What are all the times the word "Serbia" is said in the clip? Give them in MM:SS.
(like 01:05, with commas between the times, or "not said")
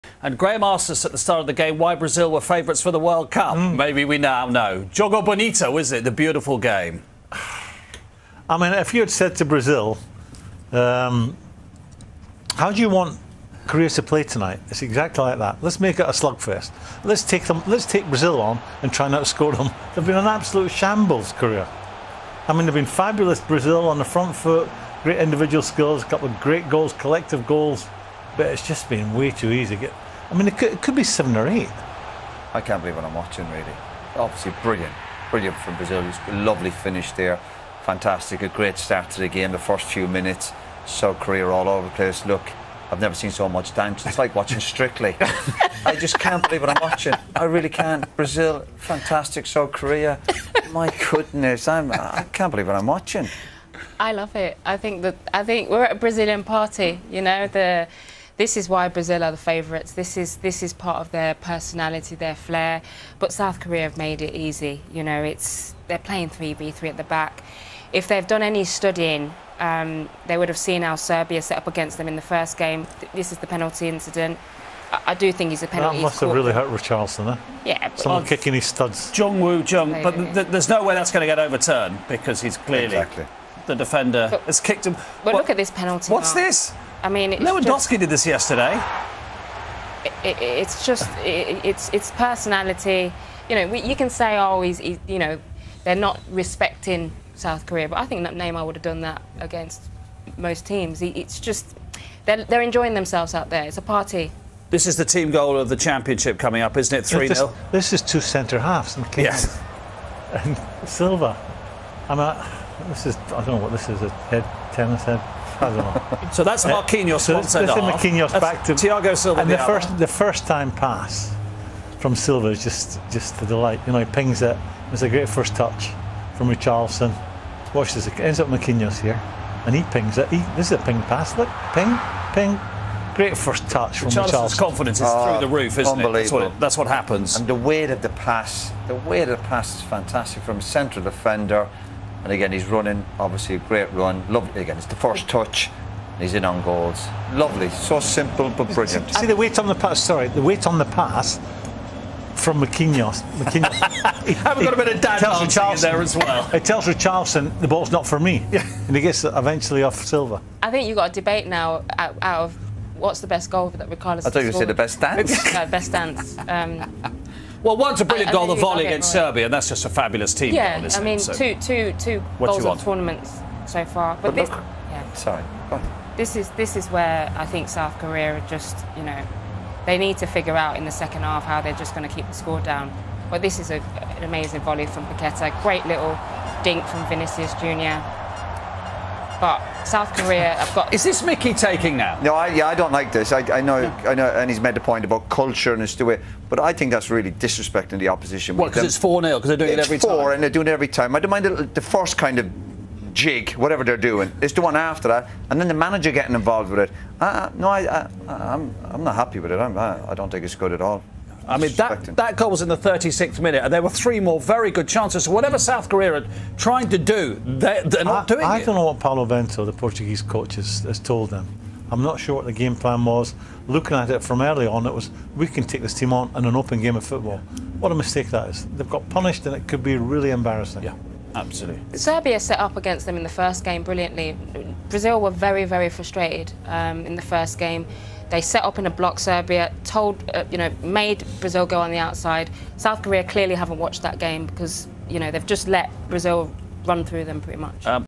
01:10, 02:49, 03:51, 03:59.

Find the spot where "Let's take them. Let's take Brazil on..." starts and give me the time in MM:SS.
00:17.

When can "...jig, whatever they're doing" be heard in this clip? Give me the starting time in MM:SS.
03:23.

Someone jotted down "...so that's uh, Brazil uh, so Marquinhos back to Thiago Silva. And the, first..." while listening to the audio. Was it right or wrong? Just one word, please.
wrong.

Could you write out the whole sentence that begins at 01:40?
He, it's just they're, they're enjoying themselves out there.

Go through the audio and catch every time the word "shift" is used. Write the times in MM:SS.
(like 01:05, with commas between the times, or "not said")
not said.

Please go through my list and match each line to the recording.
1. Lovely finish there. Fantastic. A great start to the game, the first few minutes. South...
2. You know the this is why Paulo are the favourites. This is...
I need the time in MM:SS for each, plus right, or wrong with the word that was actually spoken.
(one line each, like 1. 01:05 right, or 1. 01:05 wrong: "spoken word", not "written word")
1. 00:36 right
2. 00:57 wrong: "Brazil", not "Paulo".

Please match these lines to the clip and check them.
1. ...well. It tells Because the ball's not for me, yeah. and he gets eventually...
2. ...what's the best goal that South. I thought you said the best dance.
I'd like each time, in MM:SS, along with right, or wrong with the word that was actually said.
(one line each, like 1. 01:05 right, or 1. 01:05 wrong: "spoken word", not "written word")
1. 02:36 wrong: "Richarlison", not "Because"
2. 02:42 wrong: "Ricardo", not "South".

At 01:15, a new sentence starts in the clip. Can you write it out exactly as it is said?
That must have really hurt Richarlison, eh?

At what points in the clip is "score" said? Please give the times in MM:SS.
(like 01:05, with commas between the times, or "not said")
00:19, 03:02.